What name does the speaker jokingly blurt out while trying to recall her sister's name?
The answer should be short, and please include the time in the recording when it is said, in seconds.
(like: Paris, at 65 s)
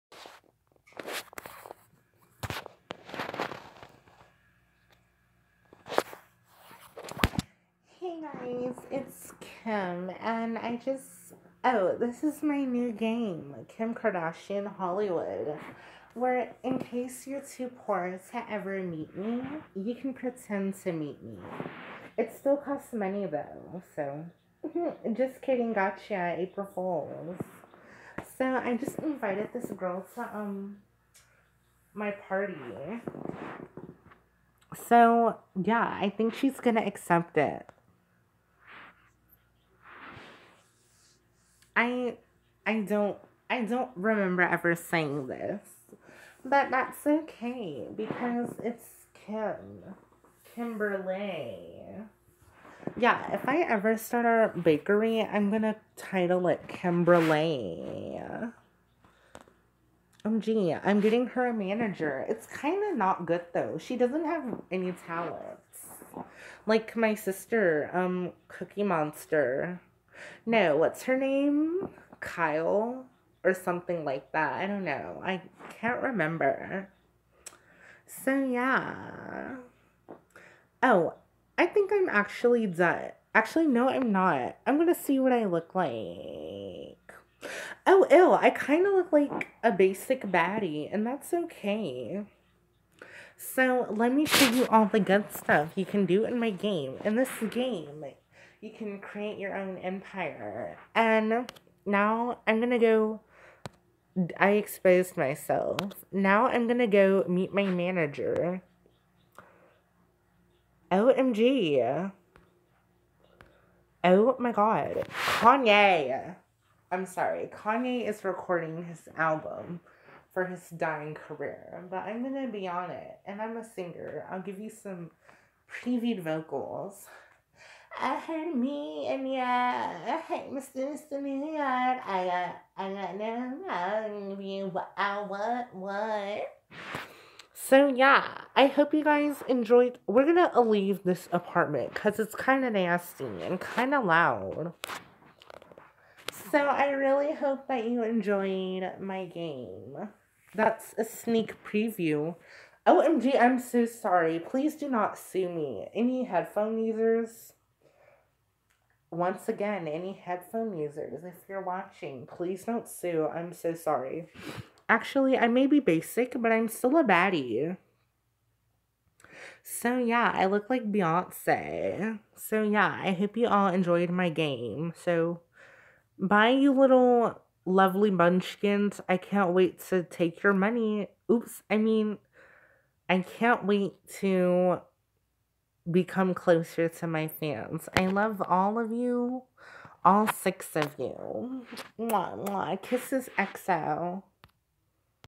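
Cookie Monster, at 68 s.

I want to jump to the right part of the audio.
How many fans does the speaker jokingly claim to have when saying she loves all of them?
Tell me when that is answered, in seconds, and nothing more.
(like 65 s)
190 s.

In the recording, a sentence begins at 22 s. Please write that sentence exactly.
It still costs money though, so.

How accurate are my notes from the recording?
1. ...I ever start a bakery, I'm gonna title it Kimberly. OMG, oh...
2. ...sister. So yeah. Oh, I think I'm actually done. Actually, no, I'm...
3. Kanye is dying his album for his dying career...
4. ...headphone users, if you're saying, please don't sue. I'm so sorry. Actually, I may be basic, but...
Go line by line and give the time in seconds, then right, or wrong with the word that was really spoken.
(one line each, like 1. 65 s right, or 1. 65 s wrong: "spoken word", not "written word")
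1. 53 s right
2. 76 s wrong: "remember", not "sister"
3. 117 s wrong: "recording", not "dying"
4. 160 s wrong: "watching", not "saying".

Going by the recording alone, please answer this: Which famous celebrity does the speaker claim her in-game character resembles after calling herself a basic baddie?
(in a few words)
Beyonce.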